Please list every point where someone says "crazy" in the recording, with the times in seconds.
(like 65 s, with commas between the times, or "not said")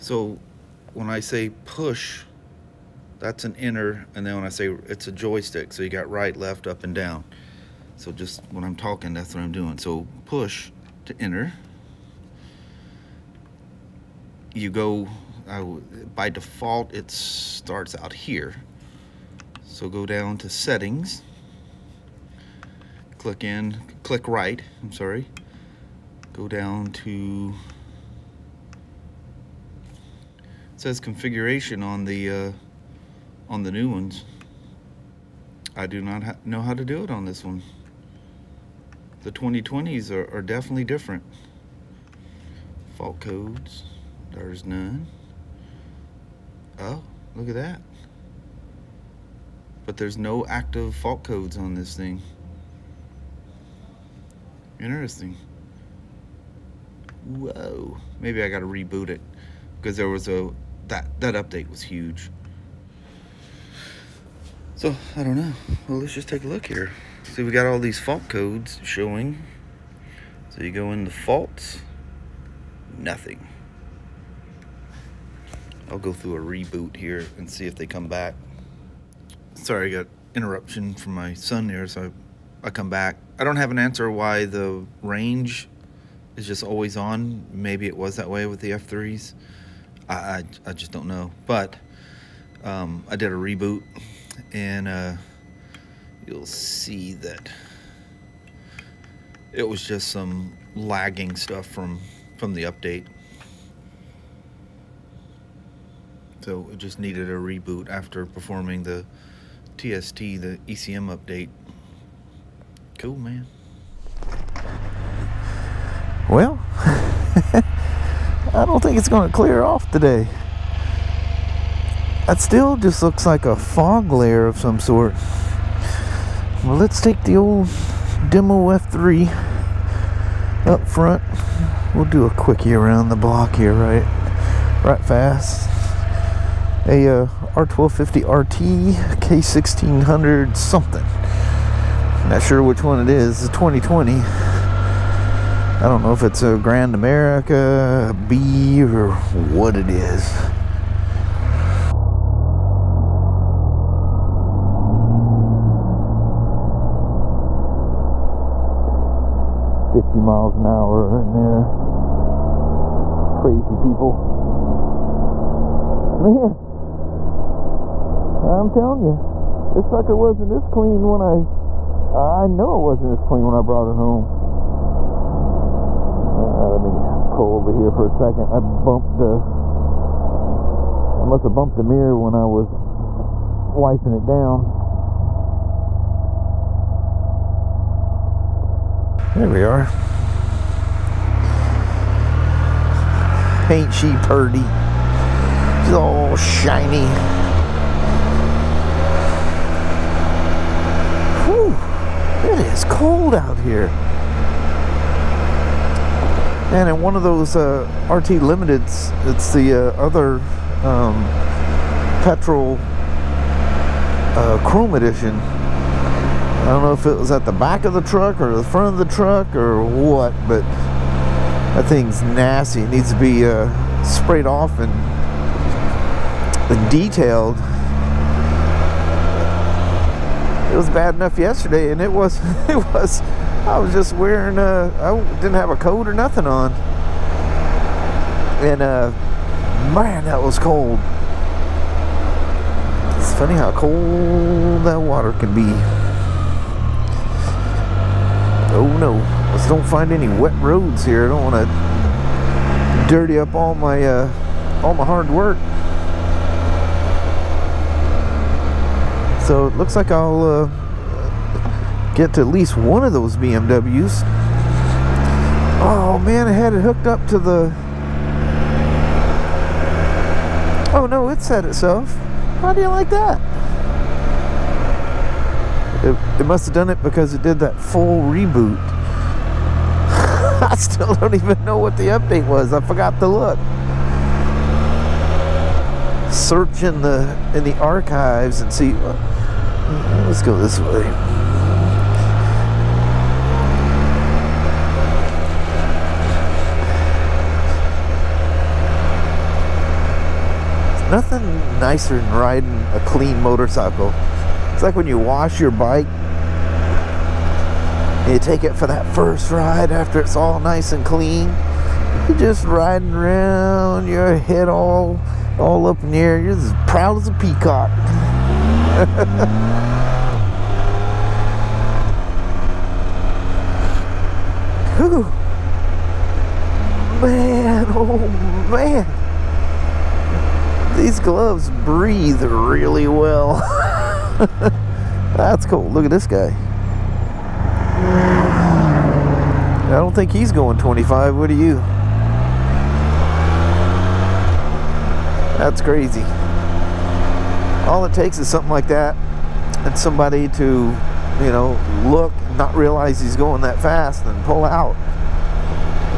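163 s, 345 s.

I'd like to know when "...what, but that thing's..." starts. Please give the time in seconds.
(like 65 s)
219 s.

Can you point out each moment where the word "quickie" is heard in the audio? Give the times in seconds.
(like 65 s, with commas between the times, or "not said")
132 s.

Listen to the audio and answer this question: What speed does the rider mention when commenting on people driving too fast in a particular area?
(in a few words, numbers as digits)
50 miles an hour.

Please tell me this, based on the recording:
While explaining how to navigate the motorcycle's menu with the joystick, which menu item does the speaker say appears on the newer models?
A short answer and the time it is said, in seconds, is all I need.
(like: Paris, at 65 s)
Configuration, at 30 s.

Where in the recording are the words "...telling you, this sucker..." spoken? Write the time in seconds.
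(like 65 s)
168 s.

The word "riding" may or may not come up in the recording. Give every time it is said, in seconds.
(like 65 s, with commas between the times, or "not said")
302 s, 312 s.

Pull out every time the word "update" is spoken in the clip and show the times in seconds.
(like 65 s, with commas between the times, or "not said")
61 s, 102 s, 111 s, 282 s.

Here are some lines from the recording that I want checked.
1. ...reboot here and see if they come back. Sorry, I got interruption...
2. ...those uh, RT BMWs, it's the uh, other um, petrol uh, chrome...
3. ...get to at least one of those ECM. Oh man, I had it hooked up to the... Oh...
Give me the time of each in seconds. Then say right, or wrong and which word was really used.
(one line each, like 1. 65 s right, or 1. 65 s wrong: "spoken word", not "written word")
1. 76 s right
2. 207 s wrong: "Limiteds", not "BMWs"
3. 262 s wrong: "BMWs", not "ECM".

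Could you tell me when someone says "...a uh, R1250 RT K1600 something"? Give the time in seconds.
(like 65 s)
136 s.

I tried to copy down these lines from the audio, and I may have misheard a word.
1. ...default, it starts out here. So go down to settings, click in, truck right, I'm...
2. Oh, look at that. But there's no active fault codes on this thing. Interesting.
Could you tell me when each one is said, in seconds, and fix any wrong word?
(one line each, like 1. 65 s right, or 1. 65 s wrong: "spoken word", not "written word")
1. 16 s wrong: "click", not "truck"
2. 46 s right.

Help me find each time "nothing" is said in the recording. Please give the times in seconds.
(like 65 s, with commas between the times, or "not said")
72 s, 236 s, 301 s.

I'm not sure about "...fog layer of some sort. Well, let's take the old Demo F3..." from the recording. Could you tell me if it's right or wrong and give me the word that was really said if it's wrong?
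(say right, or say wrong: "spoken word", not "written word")
right.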